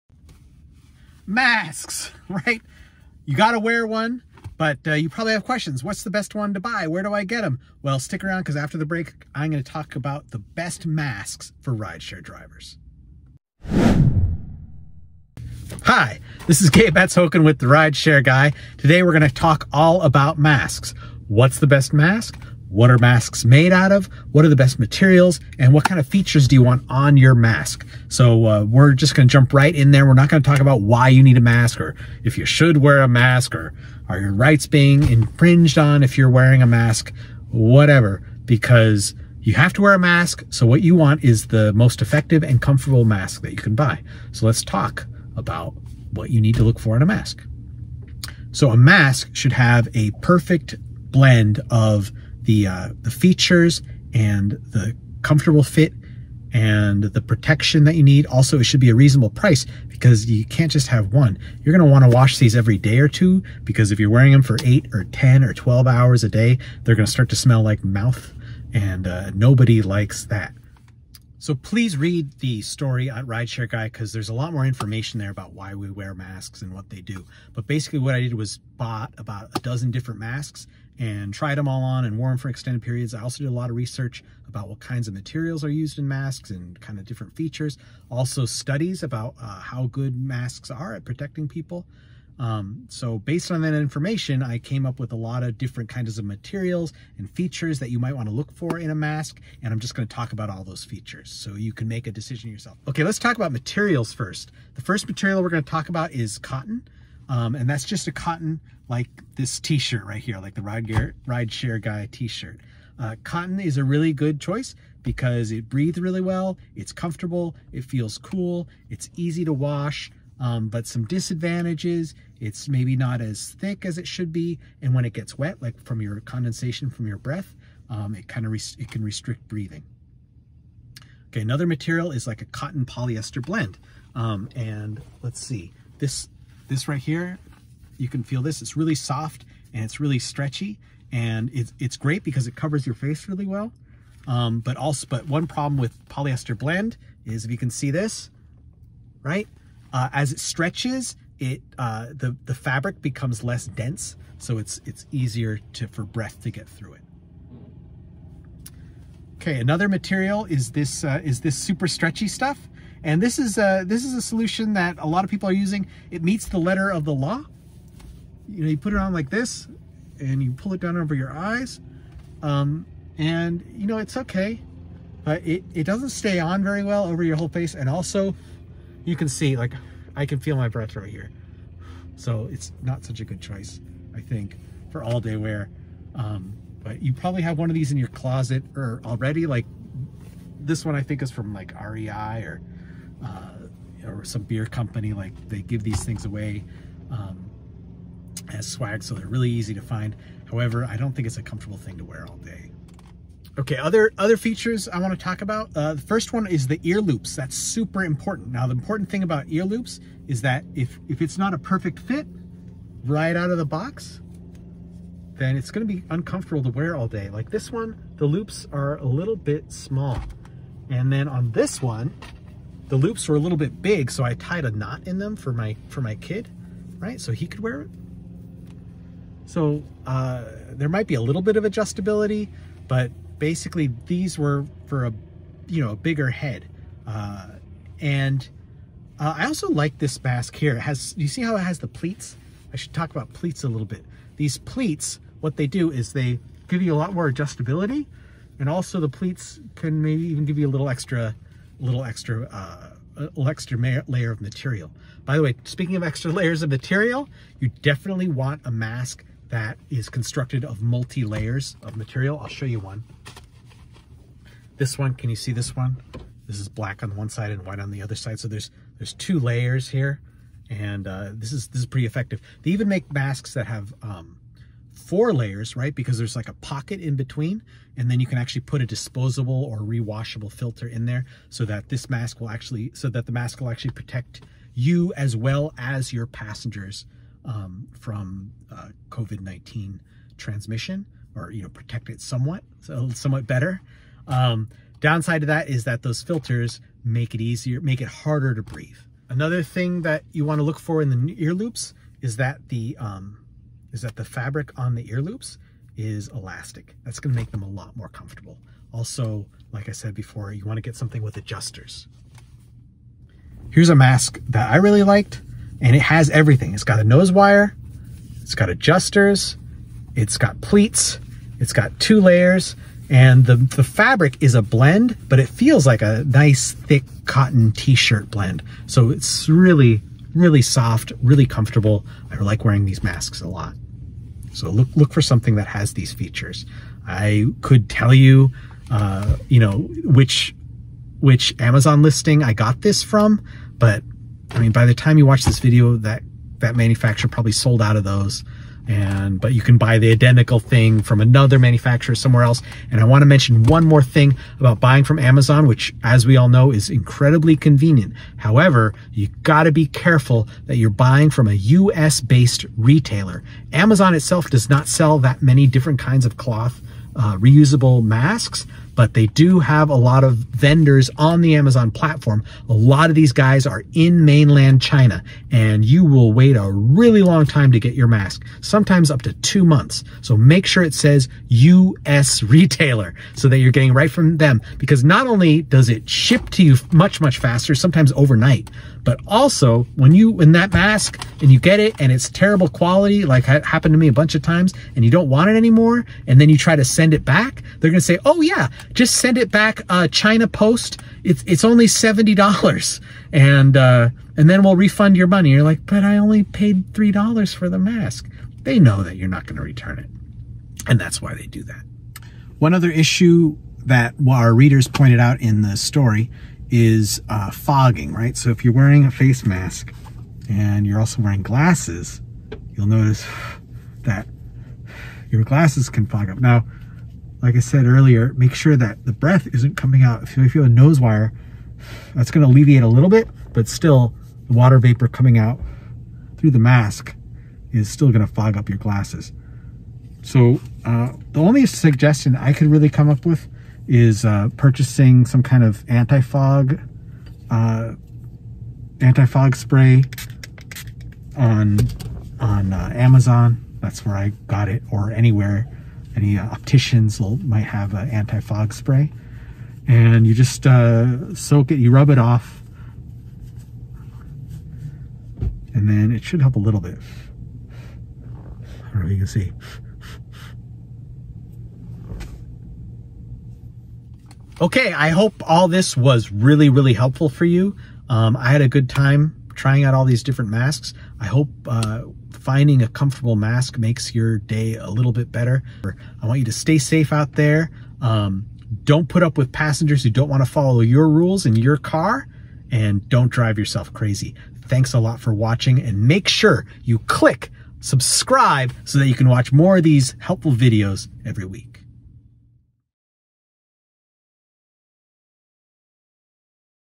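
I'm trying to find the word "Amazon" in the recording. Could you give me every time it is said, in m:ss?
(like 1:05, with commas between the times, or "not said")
5:41, 5:55, 6:03, 6:11, 7:32.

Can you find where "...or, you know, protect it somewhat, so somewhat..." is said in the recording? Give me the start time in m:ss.
4:51.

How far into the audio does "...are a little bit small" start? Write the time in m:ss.
3:38.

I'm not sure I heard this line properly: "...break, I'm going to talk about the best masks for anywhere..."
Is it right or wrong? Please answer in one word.
wrong.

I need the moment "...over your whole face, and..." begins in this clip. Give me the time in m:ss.
2:57.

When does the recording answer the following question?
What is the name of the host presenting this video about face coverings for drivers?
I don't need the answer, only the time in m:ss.
0:16.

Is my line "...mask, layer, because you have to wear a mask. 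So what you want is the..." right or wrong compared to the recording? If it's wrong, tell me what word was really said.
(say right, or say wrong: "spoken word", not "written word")
wrong: "whatever", not "layer".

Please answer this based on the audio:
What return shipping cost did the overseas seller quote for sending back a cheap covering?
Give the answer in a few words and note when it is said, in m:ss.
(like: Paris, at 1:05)
$70, at 6:41.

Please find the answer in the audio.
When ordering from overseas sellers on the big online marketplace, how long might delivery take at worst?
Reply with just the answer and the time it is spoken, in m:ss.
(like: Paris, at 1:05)
2 months, at 6:19.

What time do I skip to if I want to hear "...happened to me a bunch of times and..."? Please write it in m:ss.
6:33.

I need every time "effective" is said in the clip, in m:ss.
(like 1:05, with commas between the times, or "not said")
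0:42, 4:32.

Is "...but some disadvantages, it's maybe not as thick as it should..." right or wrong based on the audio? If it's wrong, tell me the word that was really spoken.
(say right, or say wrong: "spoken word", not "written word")
right.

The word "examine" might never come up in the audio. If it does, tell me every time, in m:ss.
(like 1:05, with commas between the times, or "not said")
not said.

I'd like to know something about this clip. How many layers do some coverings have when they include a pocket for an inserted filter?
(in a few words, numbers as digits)
4.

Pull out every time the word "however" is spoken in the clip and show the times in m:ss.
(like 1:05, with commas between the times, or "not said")
3:20, 5:58.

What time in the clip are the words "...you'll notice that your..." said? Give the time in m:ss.
7:02.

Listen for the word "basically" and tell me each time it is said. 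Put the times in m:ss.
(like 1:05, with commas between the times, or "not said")
1:17, 3:53.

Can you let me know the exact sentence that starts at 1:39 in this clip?
And I'm just going to talk about all those features so you can make a decision yourself.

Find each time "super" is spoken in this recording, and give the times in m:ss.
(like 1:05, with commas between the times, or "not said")
2:41, 3:27.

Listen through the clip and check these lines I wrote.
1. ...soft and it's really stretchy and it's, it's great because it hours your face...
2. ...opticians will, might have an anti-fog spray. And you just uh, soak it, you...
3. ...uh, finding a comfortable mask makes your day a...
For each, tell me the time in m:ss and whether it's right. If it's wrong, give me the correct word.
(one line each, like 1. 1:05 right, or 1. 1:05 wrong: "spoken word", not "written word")
1. 2:18 wrong: "covers", not "hours"
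2. 7:36 right
3. 8:01 right.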